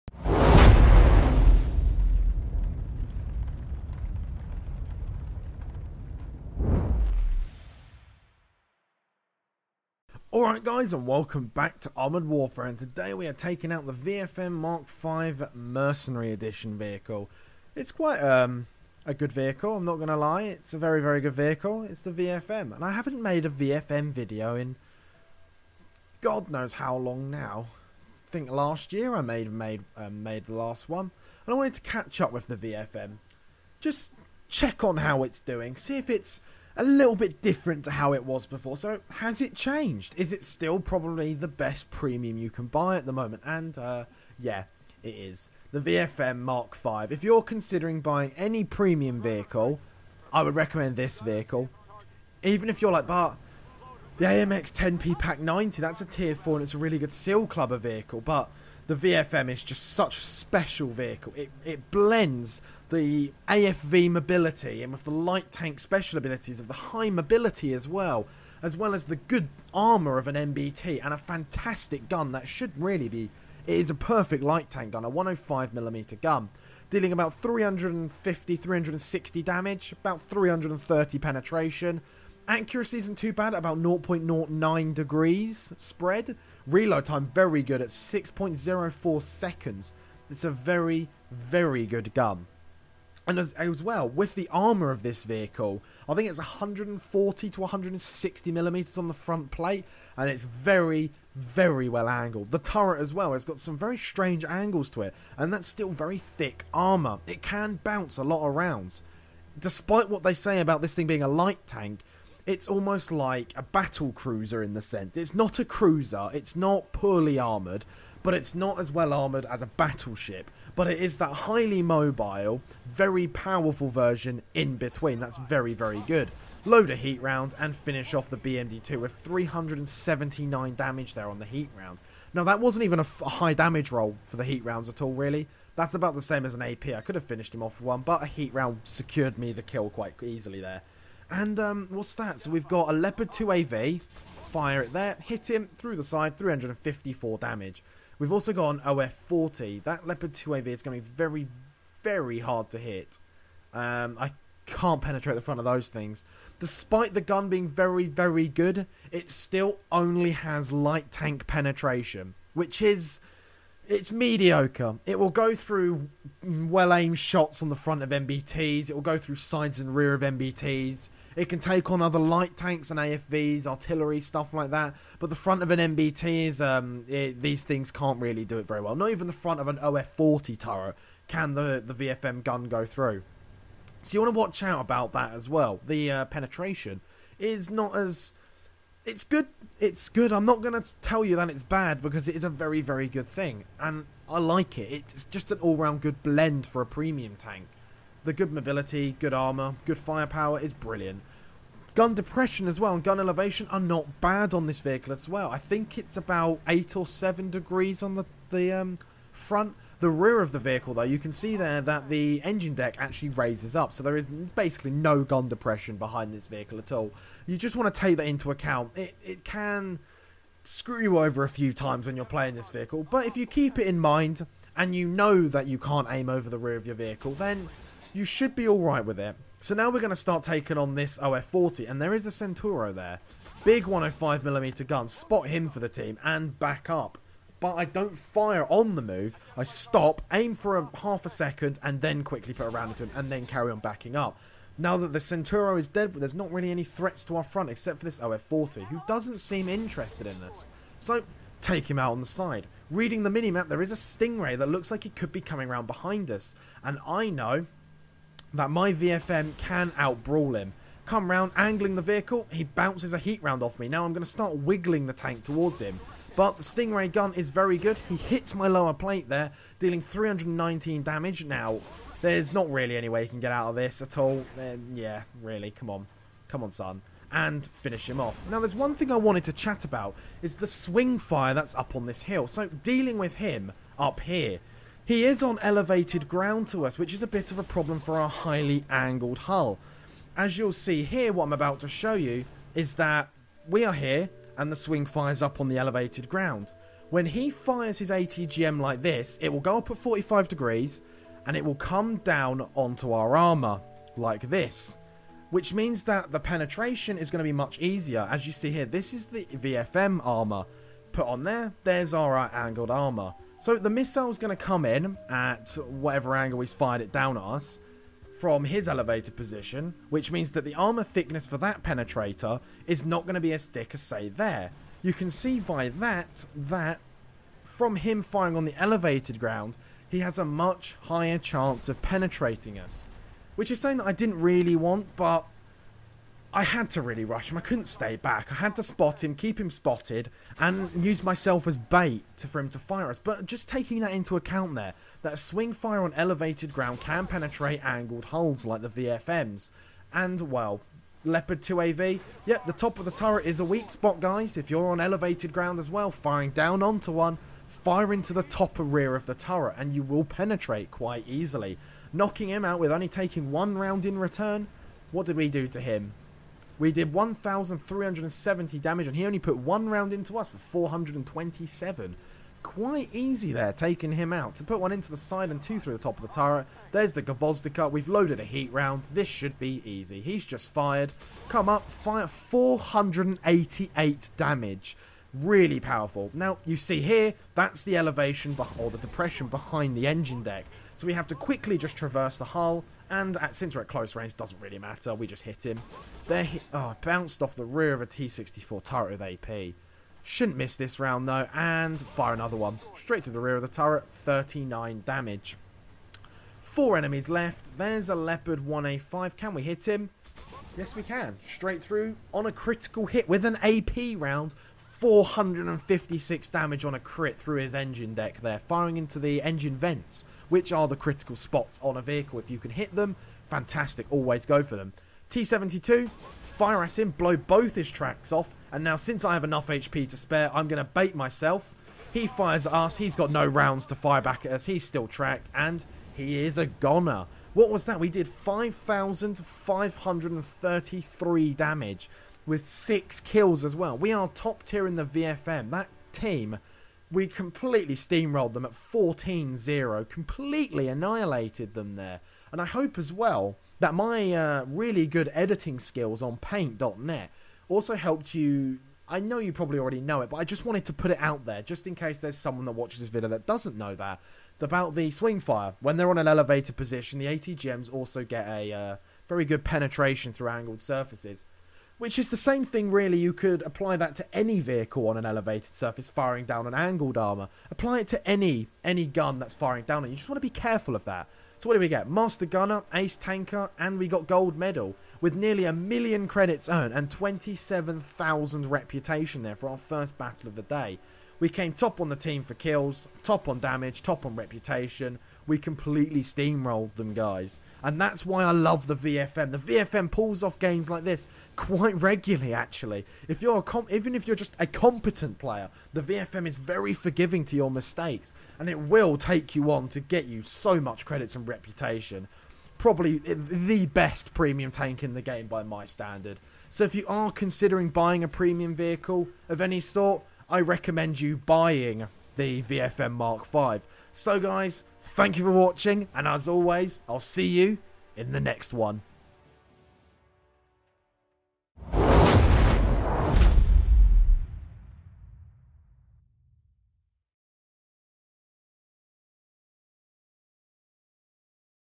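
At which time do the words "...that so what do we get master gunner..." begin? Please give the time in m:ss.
8:01.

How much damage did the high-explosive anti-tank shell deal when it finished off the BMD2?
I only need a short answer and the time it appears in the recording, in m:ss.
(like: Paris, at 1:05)
379, at 2:09.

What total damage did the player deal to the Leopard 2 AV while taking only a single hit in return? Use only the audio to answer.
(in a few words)
1,370.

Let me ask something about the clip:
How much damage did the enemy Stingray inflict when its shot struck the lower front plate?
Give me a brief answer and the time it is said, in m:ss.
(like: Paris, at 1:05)
319, at 4:29.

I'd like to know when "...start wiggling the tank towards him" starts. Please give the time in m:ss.
4:24.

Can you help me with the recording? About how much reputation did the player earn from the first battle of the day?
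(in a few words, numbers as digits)
27,000.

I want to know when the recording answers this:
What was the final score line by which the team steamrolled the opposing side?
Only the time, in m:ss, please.
7:28.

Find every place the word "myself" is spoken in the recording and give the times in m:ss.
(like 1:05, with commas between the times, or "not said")
5:41, 7:11.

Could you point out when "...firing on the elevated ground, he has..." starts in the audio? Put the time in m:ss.
5:28.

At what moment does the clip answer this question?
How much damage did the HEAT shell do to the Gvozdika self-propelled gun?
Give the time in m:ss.
6:22.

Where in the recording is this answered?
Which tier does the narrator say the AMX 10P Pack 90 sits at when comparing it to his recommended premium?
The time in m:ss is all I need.
0:56.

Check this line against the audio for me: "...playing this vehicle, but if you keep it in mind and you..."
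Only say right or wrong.
right.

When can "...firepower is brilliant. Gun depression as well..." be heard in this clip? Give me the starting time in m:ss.
3:19.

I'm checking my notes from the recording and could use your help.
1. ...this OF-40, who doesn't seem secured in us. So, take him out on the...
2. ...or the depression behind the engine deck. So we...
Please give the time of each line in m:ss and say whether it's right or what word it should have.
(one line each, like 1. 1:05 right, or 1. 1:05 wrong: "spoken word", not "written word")
1. 4:08 wrong: "interested", not "secured"
2. 6:28 right.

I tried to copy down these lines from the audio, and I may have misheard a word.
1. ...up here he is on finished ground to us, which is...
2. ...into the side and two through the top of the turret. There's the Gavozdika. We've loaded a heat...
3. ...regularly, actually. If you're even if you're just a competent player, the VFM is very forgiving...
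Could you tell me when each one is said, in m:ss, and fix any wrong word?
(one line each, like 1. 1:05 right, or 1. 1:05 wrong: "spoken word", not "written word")
1. 4:43 wrong: "elevated", not "finished"
2. 6:14 right
3. 8:21 right.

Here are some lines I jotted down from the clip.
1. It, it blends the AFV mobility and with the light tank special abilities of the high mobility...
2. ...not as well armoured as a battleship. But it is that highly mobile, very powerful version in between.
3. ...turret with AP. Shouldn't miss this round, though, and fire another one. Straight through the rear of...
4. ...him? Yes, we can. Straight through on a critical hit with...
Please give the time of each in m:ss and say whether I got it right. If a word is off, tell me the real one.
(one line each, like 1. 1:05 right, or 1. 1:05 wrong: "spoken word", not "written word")
1. 1:01 right
2. 1:58 right
3. 6:38 right
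4. 6:49 right.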